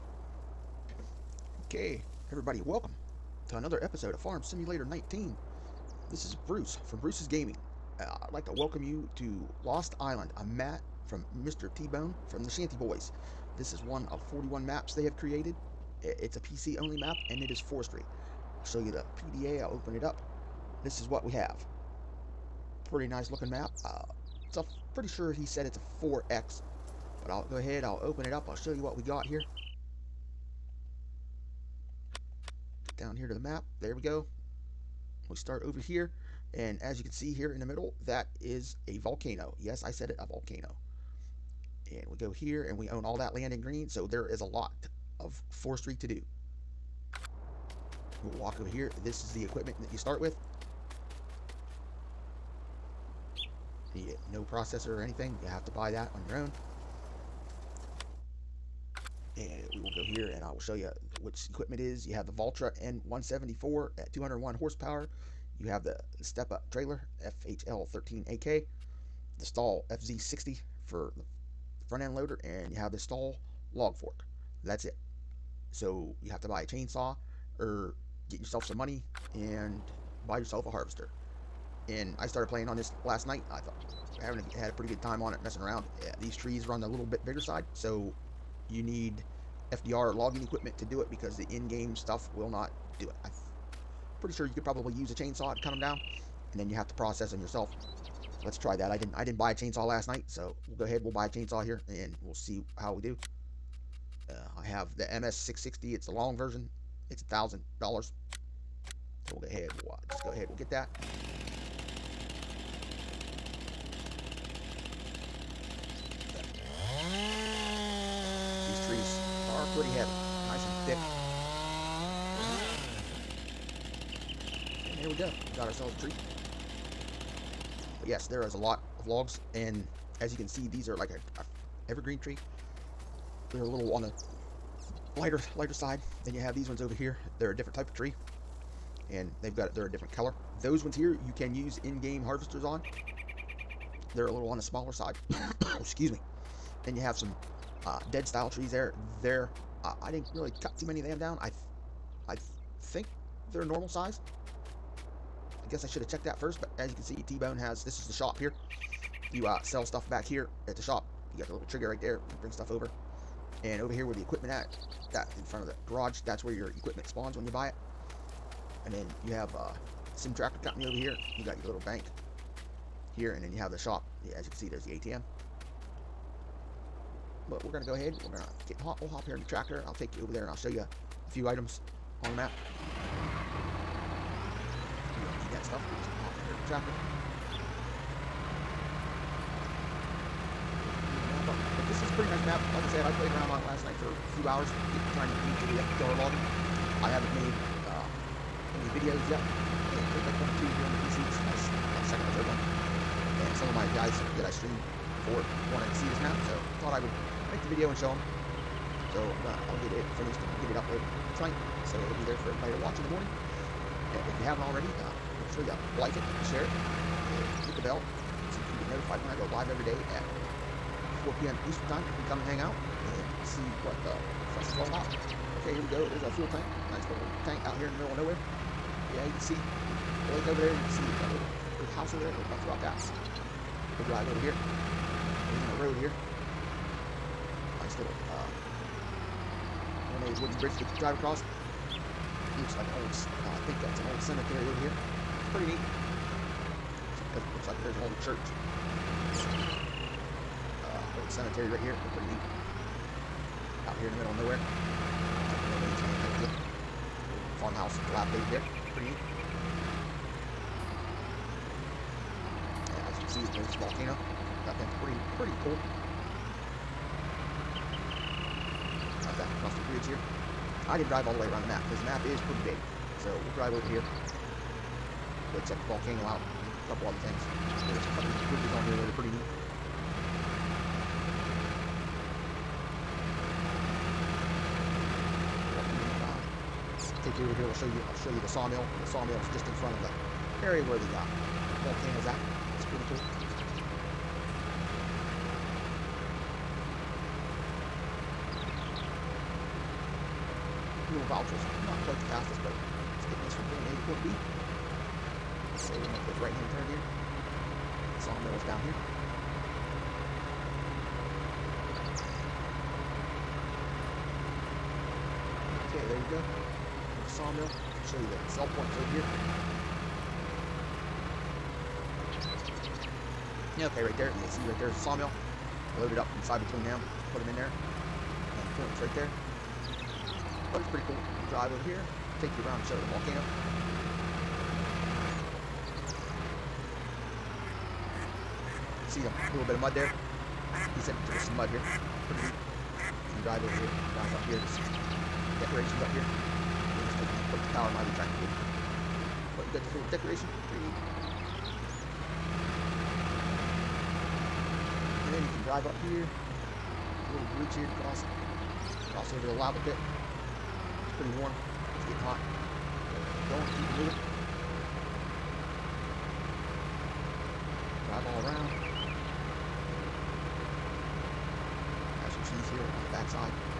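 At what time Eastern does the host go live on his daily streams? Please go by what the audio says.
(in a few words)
4 p.m.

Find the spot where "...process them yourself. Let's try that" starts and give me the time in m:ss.
1:36.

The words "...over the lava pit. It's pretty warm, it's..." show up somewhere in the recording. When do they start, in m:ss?
5:59.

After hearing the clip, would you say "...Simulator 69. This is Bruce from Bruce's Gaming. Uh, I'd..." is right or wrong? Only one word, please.
wrong.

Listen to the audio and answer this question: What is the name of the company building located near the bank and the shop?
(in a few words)
Sim Tractor Company.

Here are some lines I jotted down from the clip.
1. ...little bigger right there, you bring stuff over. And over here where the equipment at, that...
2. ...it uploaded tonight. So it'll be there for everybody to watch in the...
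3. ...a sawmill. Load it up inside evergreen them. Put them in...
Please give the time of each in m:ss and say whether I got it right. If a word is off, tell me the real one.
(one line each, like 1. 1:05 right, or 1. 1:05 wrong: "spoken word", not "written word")
1. 2:41 wrong: "trigger", not "bigger"
2. 3:30 right
3. 5:24 wrong: "between", not "evergreen".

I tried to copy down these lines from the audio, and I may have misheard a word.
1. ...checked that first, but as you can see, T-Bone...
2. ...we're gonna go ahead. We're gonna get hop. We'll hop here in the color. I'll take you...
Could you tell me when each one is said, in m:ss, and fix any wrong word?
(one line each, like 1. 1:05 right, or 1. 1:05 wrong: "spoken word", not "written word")
1. 2:36 right
2. 2:57 wrong: "tractor", not "color".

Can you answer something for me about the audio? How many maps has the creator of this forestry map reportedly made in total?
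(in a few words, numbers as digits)
41.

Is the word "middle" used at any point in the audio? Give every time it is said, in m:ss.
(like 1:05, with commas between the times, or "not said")
0:37, 3:48, 4:14.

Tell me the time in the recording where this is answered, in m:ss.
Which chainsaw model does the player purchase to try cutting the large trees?
1:45.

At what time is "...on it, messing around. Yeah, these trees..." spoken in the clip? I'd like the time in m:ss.
1:25.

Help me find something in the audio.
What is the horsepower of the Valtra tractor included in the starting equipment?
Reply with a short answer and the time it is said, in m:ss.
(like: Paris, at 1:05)
201, at 1:04.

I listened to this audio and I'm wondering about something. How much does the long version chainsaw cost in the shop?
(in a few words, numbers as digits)
$1,000.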